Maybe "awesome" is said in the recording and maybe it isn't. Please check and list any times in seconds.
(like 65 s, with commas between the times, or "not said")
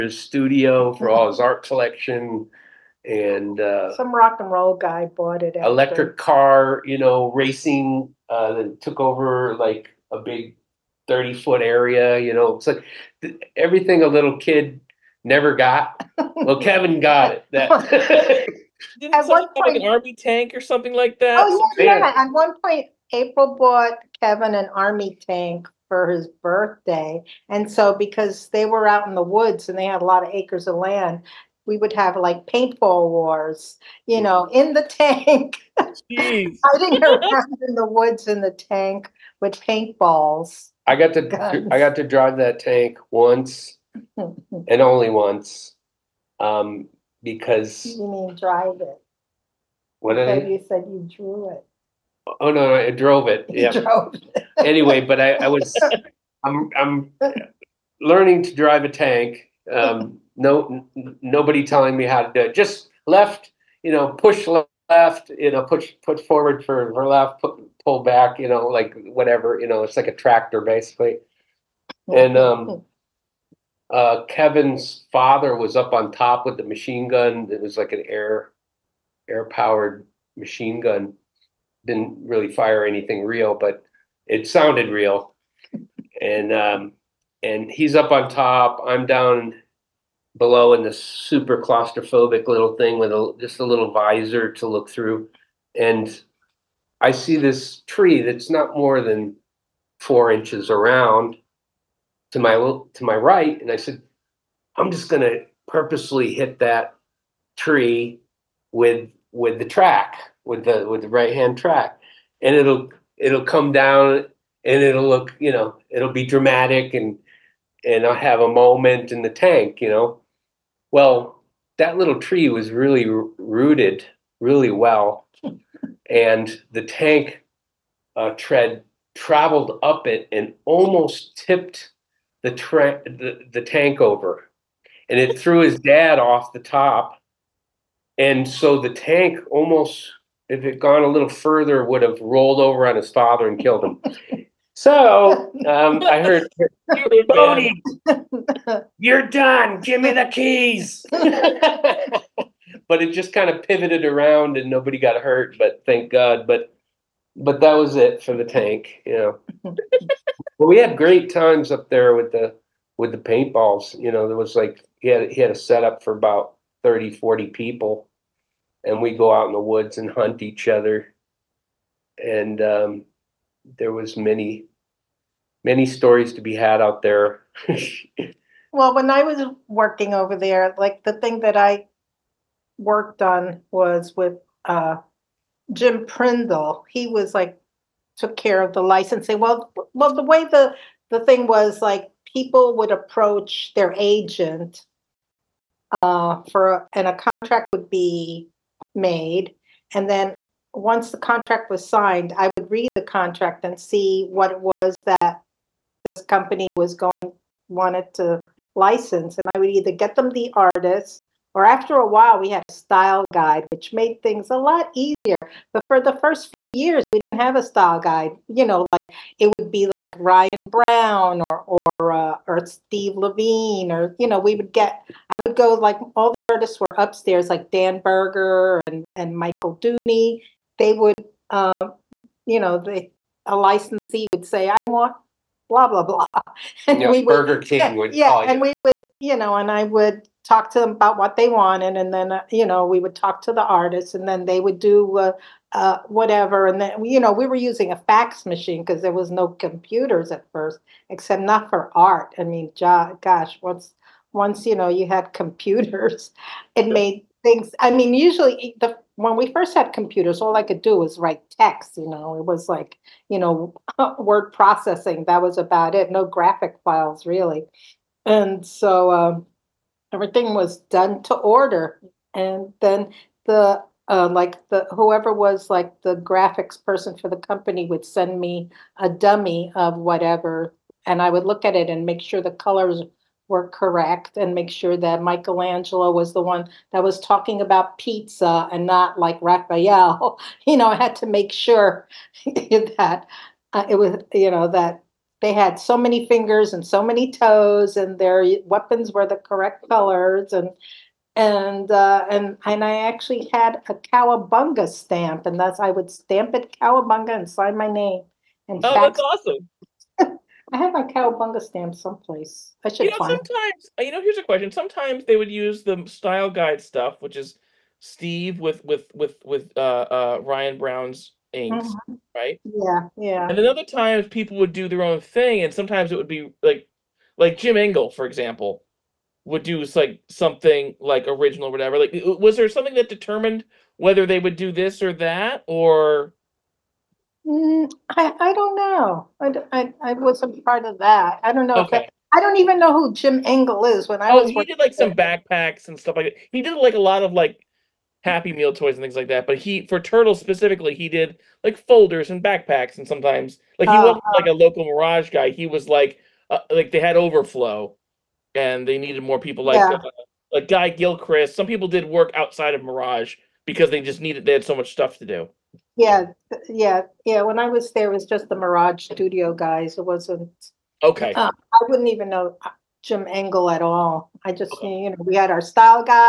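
309 s.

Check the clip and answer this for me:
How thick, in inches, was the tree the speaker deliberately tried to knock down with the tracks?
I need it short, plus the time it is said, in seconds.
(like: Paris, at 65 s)
4, at 99 s.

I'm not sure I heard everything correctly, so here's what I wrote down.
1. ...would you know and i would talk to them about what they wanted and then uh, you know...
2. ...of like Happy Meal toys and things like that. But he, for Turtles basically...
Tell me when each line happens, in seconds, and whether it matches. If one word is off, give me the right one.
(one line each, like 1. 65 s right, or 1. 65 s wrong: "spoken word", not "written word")
1. 238 s right
2. 347 s wrong: "specifically", not "basically".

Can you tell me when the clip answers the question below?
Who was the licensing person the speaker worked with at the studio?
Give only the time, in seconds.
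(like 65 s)
185 s.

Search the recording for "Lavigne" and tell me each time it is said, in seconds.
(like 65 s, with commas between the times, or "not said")
223 s.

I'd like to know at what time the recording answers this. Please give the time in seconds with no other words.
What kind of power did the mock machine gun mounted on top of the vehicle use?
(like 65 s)
79 s.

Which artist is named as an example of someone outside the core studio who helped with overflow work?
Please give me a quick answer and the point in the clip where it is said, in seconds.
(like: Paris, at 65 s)
Guy Gilchrist, at 360 s.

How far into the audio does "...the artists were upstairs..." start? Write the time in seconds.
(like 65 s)
226 s.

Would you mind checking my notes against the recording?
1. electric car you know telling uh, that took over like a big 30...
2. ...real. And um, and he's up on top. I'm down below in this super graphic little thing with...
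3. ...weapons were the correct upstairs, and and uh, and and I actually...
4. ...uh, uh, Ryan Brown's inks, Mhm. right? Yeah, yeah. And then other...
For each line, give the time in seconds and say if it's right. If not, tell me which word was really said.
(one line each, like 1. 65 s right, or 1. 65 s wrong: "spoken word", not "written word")
1. 5 s wrong: "racing", not "telling"
2. 84 s wrong: "claustrophobic", not "graphic"
3. 298 s wrong: "colors", not "upstairs"
4. 319 s right.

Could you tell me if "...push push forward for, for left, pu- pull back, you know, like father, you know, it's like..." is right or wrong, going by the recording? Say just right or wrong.
wrong.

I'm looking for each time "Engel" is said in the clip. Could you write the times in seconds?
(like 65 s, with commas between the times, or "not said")
327 s, 343 s, 373 s.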